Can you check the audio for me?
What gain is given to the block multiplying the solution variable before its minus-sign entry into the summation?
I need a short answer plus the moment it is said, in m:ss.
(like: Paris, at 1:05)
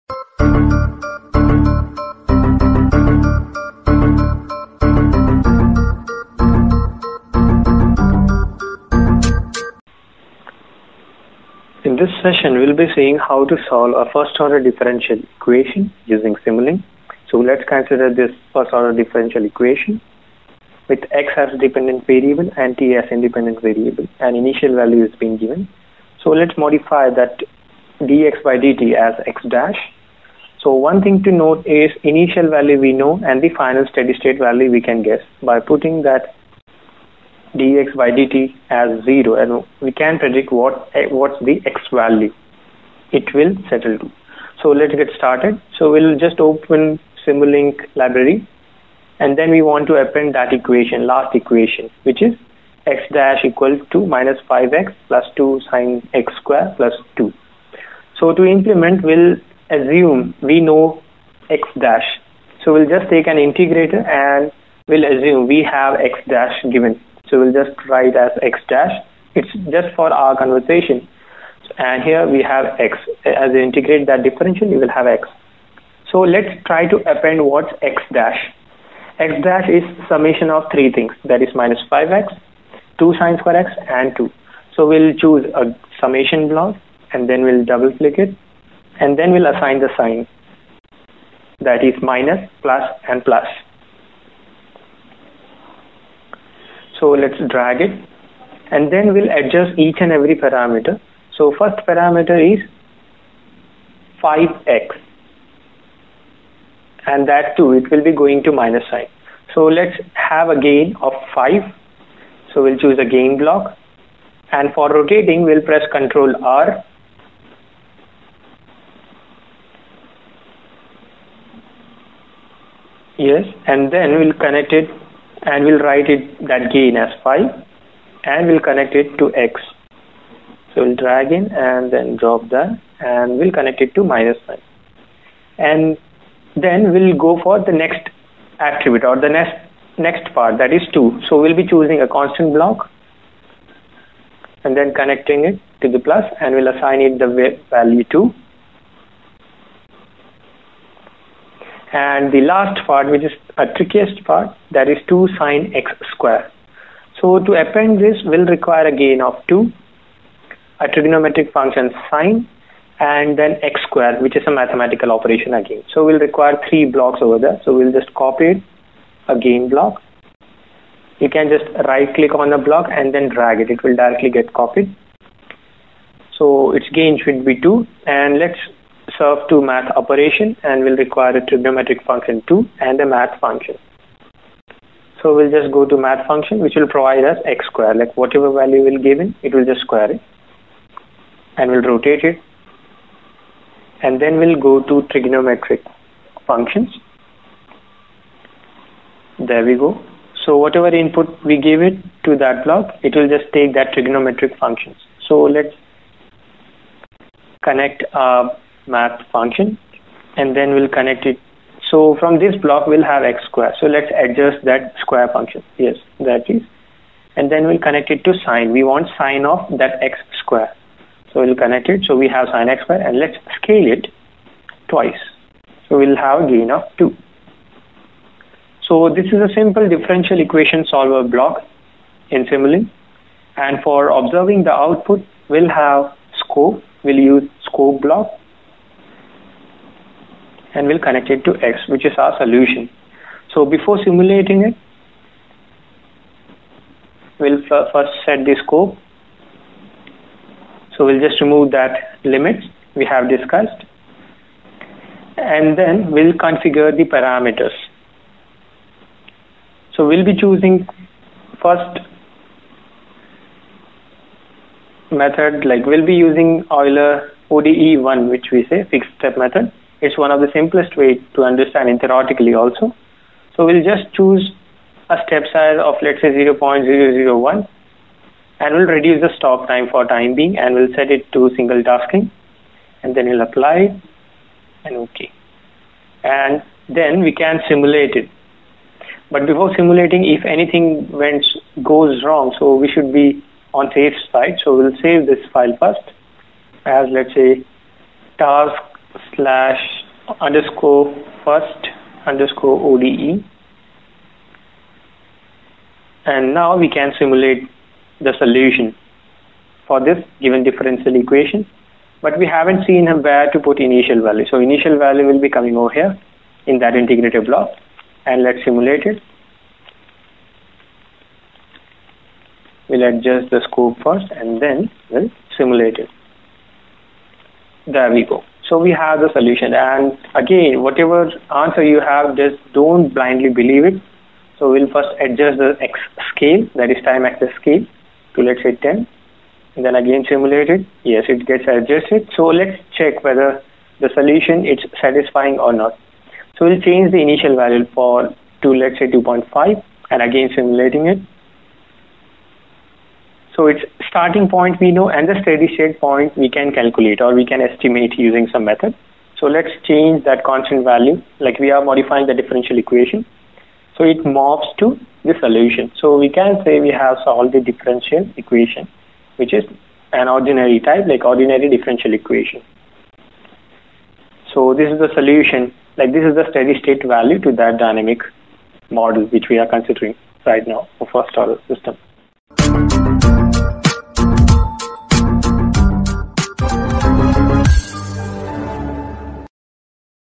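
5, at 2:05.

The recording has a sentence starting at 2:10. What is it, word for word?
So we'll drag in and then drop that and we'll connect it to minus 9.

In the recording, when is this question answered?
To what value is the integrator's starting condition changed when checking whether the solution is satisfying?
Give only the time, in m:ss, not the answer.
5:49.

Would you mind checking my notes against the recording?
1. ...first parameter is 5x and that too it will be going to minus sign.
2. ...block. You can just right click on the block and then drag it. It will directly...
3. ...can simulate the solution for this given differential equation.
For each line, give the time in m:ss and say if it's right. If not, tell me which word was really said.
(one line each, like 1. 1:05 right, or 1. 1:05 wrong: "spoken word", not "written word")
1. 1:41 right
2. 2:49 right
3. 5:06 right.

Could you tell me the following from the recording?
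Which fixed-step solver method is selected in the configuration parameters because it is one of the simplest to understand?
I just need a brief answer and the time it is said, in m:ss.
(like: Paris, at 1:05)
Euler ODE1, at 4:26.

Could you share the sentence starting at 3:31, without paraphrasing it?
So from this block we'll have x square.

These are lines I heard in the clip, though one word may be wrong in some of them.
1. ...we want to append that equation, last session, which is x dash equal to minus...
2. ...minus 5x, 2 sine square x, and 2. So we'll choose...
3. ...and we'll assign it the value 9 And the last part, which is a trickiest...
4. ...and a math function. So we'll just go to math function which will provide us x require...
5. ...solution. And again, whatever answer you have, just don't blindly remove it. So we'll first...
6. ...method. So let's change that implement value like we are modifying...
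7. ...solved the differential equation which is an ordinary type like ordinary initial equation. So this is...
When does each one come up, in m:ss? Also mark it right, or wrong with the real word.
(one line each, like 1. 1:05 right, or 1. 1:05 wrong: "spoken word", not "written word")
1. 0:49 wrong: "equation", not "session"
2. 1:21 right
3. 2:26 wrong: "2", not "9"
4. 3:02 wrong: "square", not "require"
5. 5:29 wrong: "believe", not "remove"
6. 5:58 wrong: "constant", not "implement"
7. 6:07 wrong: "differential", not "initial".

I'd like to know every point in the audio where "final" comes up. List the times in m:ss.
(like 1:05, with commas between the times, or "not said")
0:33.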